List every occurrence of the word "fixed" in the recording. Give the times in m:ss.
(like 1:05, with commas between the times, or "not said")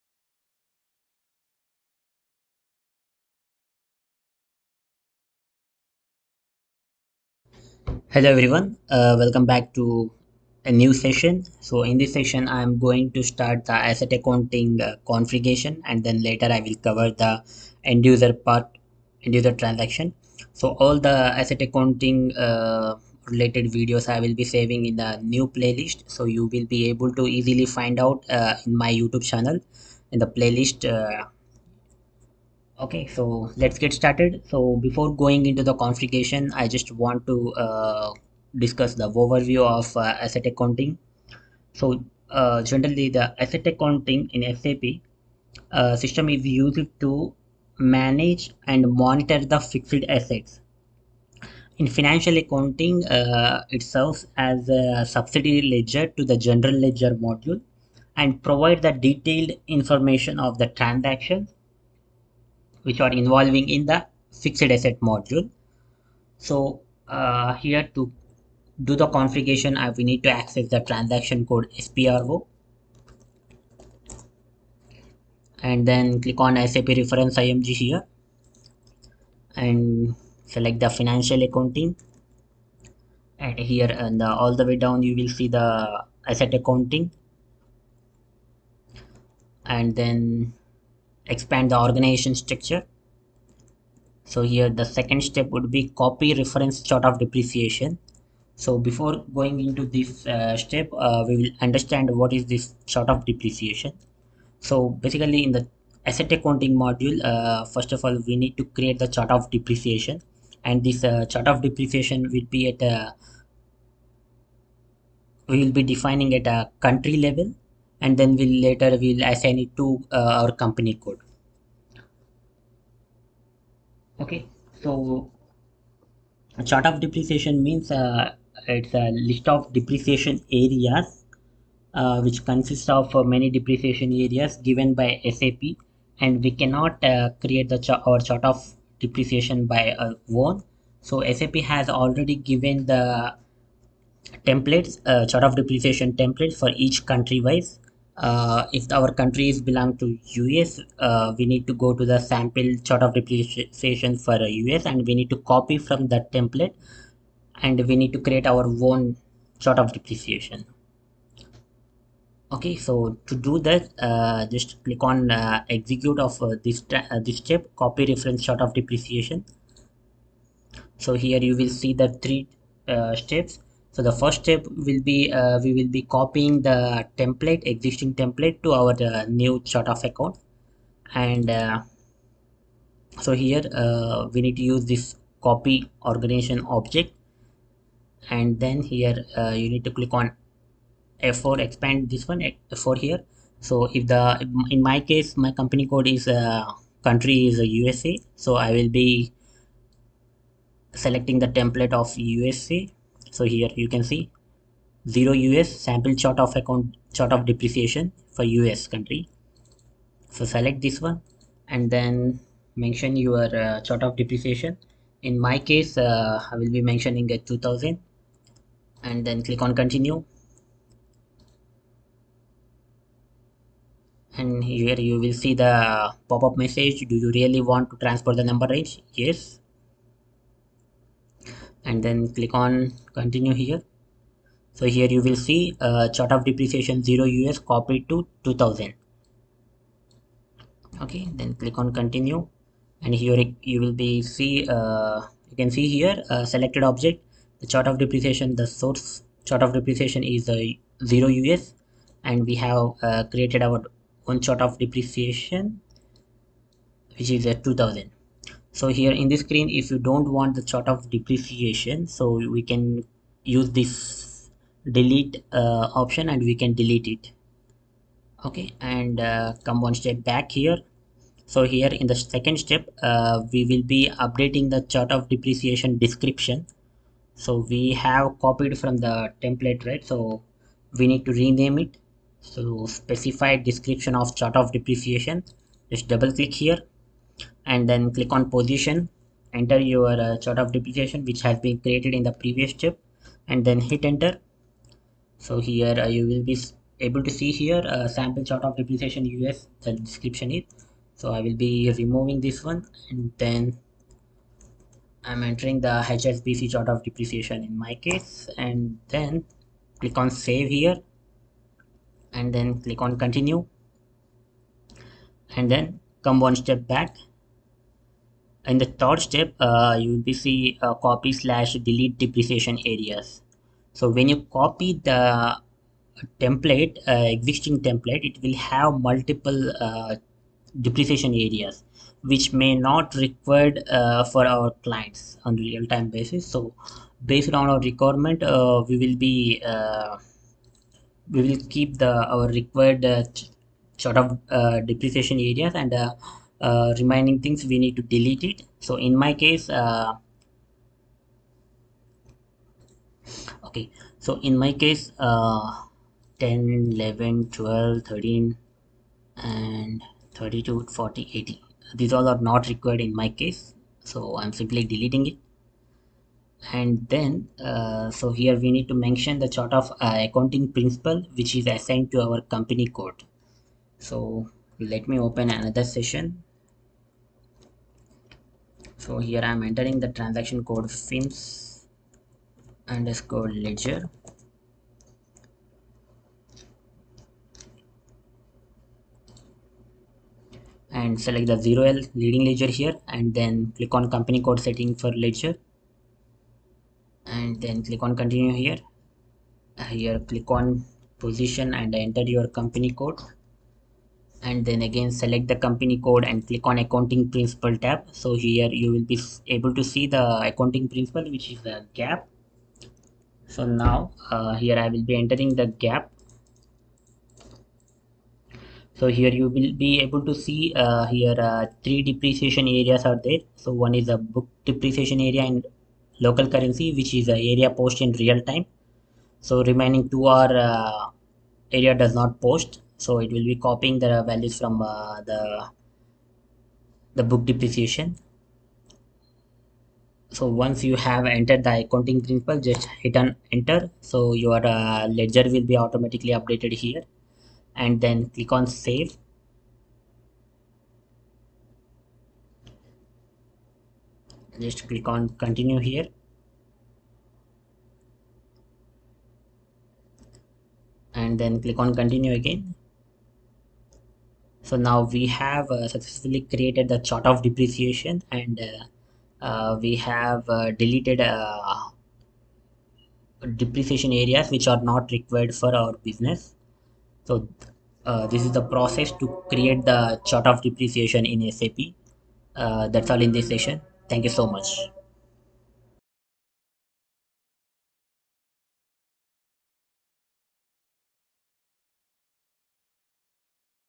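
0:49, 1:04.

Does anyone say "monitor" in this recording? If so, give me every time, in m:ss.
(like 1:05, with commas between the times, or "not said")
0:49.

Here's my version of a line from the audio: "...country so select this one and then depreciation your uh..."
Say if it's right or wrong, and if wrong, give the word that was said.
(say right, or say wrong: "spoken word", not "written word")
wrong: "mention", not "depreciation".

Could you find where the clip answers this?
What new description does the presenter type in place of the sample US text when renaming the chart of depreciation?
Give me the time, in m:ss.
5:06.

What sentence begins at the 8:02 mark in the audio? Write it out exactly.
Uh, that's all in this session.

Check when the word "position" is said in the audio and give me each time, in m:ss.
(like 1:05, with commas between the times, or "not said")
4:48, 6:41.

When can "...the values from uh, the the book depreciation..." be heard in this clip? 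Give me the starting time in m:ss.
7:14.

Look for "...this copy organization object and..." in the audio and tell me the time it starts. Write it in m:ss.
3:04.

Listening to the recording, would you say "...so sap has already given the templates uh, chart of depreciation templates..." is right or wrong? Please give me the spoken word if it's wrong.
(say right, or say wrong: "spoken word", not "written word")
right.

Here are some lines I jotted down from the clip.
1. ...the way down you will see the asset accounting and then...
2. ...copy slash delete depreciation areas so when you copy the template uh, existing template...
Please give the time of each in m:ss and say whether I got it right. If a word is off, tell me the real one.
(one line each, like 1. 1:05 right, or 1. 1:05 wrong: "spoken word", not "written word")
1. 1:24 right
2. 5:20 right.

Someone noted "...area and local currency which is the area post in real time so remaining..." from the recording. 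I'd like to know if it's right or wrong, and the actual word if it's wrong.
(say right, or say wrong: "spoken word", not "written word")
right.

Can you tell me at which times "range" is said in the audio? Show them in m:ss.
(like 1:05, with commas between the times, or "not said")
3:48.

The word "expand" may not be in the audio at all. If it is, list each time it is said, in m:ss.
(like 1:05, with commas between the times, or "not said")
1:31, 3:11.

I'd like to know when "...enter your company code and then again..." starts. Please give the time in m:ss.
6:42.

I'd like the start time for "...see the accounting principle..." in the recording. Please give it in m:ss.
6:49.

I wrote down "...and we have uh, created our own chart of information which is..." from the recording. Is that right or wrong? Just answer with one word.
wrong.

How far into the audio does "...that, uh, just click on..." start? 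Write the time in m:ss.
2:43.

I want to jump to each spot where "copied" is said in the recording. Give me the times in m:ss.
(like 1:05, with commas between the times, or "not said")
3:57, 4:38.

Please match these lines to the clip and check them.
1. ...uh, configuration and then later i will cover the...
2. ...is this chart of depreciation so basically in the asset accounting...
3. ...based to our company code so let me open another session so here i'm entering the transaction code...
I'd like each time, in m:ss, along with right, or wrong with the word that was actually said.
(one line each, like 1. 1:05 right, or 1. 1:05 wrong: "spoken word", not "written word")
1. 0:14 right
2. 1:42 right
3. 6:11 wrong: "assigned", not "based".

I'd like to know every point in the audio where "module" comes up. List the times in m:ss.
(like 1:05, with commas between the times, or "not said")
0:57, 1:04, 1:46.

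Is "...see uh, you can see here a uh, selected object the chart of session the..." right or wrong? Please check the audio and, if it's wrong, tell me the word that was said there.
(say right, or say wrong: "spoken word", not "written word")
wrong: "depreciation", not "session".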